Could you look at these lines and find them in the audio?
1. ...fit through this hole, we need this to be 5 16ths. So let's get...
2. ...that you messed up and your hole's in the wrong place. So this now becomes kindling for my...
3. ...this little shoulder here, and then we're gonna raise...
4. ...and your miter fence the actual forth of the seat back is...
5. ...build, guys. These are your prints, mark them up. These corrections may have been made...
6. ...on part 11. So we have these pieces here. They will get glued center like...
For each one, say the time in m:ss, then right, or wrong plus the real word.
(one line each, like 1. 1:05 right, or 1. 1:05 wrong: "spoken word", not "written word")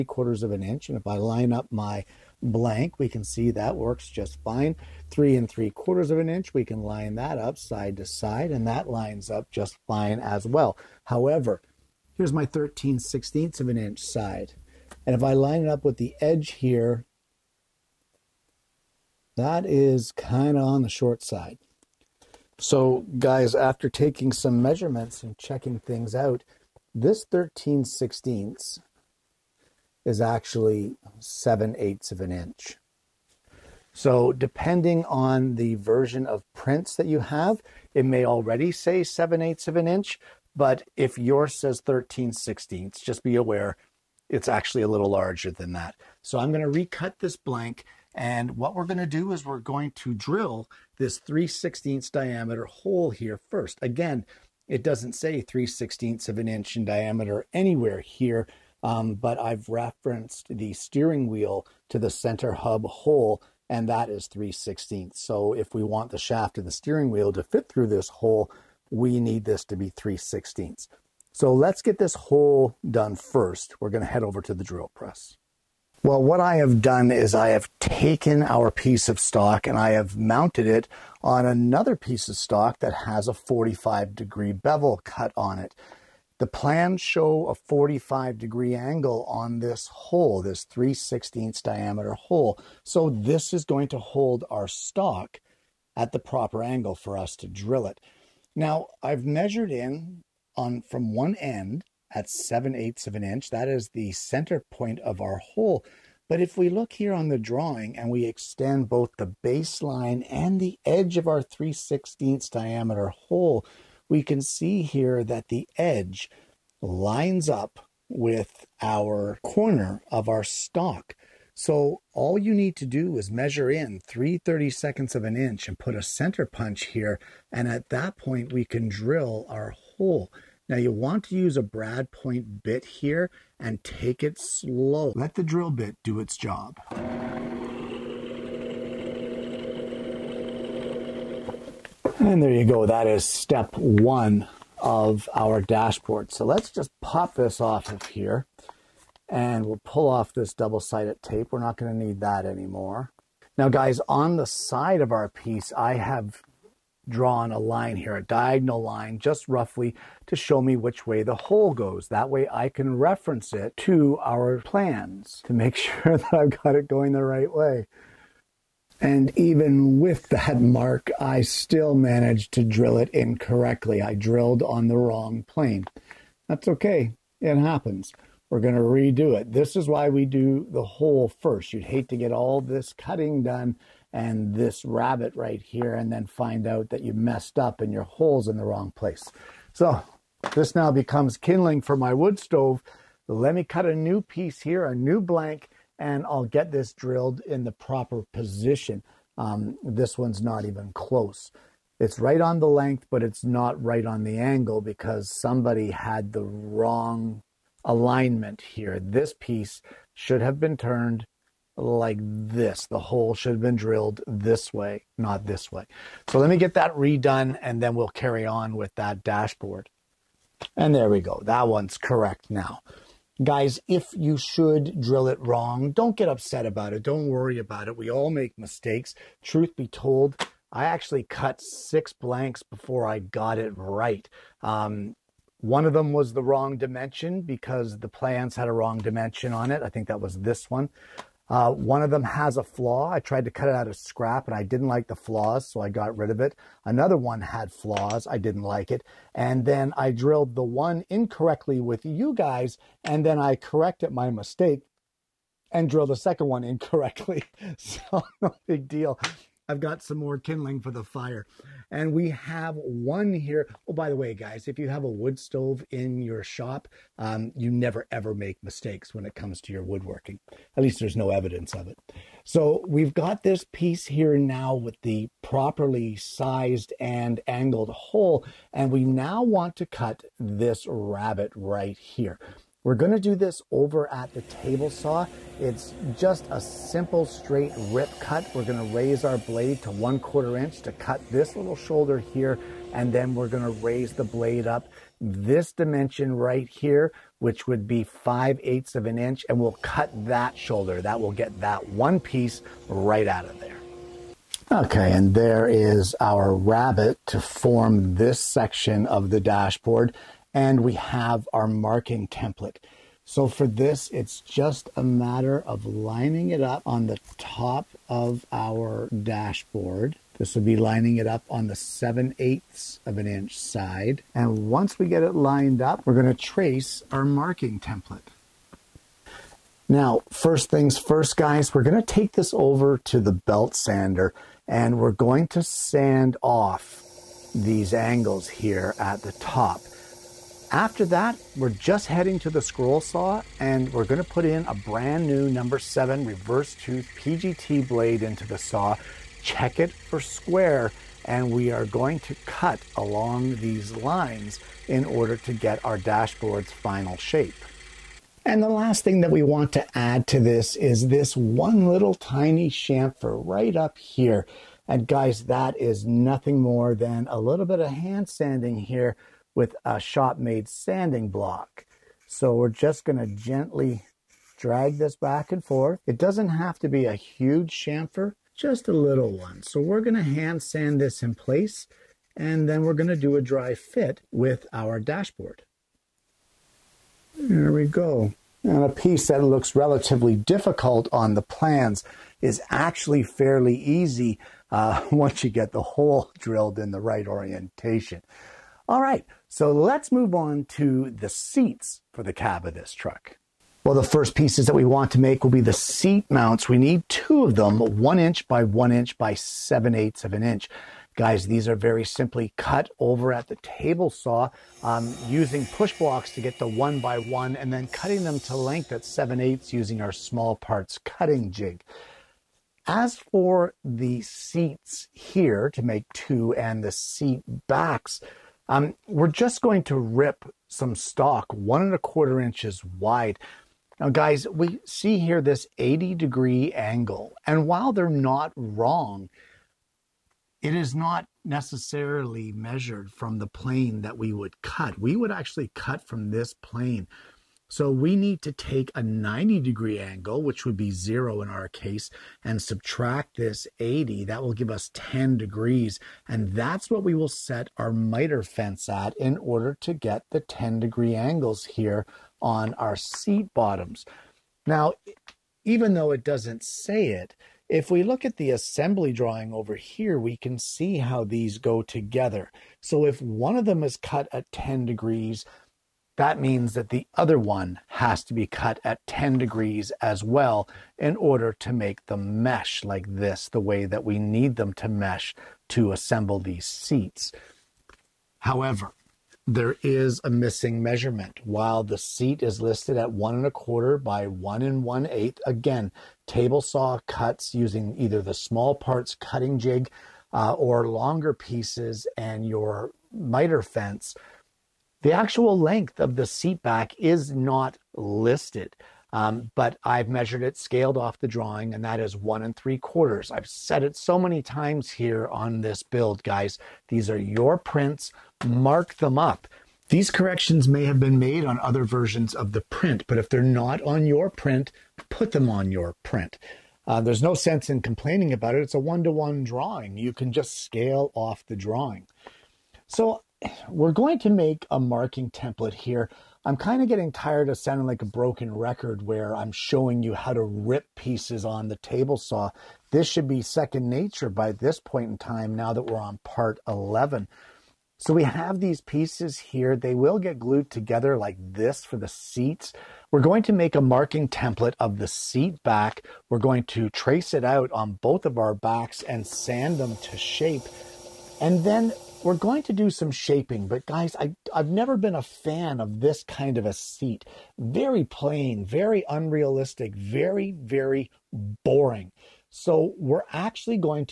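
1. 1:07 wrong: "3", not "5"
2. 3:06 right
3. 4:51 right
4. 8:22 wrong: "length", not "forth"
5. 8:35 right
6. 9:05 wrong: "together", not "center".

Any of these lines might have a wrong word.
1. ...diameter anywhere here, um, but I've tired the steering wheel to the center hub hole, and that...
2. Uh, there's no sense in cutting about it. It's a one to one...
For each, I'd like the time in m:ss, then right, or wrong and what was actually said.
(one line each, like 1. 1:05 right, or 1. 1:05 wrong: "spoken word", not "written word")
1. 0:56 wrong: "referenced", not "tired"
2. 8:46 wrong: "complaining", not "cutting".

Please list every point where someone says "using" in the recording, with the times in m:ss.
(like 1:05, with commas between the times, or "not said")
6:55, 6:59, 8:17.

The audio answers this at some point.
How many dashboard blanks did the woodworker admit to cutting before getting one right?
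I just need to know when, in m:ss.
3:51.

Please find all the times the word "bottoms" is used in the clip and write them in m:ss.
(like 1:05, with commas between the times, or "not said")
7:43.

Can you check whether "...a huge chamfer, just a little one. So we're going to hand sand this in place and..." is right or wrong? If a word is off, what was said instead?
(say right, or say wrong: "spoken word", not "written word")
right.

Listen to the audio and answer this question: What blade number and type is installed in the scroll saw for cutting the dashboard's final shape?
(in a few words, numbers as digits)
number 7 reverse tooth PGT.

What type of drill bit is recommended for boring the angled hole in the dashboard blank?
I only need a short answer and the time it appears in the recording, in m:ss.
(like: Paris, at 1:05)
brad point bit, at 2:11.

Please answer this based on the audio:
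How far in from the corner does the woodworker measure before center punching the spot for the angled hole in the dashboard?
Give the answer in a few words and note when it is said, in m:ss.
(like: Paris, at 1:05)
3/32 of an inch, at 2:04.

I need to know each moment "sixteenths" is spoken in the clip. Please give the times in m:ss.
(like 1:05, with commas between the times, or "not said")
0:12, 0:27, 0:42, 0:51.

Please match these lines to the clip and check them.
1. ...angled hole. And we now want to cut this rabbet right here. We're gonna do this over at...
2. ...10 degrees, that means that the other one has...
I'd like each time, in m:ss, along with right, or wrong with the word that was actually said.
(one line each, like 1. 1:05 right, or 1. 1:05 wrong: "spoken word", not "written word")
1. 4:37 right
2. 7:54 right.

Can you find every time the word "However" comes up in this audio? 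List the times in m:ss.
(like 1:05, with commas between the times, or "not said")
0:11, 8:08.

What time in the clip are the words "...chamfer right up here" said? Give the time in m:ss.
6:02.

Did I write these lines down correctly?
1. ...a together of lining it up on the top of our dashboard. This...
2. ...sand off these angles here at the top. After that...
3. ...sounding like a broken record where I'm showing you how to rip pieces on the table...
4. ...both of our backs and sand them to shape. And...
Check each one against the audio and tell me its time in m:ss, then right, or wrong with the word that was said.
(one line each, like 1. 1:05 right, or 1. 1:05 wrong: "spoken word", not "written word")
1. 5:14 wrong: "matter", not "together"
2. 5:35 right
3. 8:57 right
4. 9:18 right.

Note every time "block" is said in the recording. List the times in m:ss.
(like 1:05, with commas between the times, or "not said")
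6:11, 6:55.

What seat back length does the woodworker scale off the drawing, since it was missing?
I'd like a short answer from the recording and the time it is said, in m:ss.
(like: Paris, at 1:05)
1 3/4 inches, at 8:32.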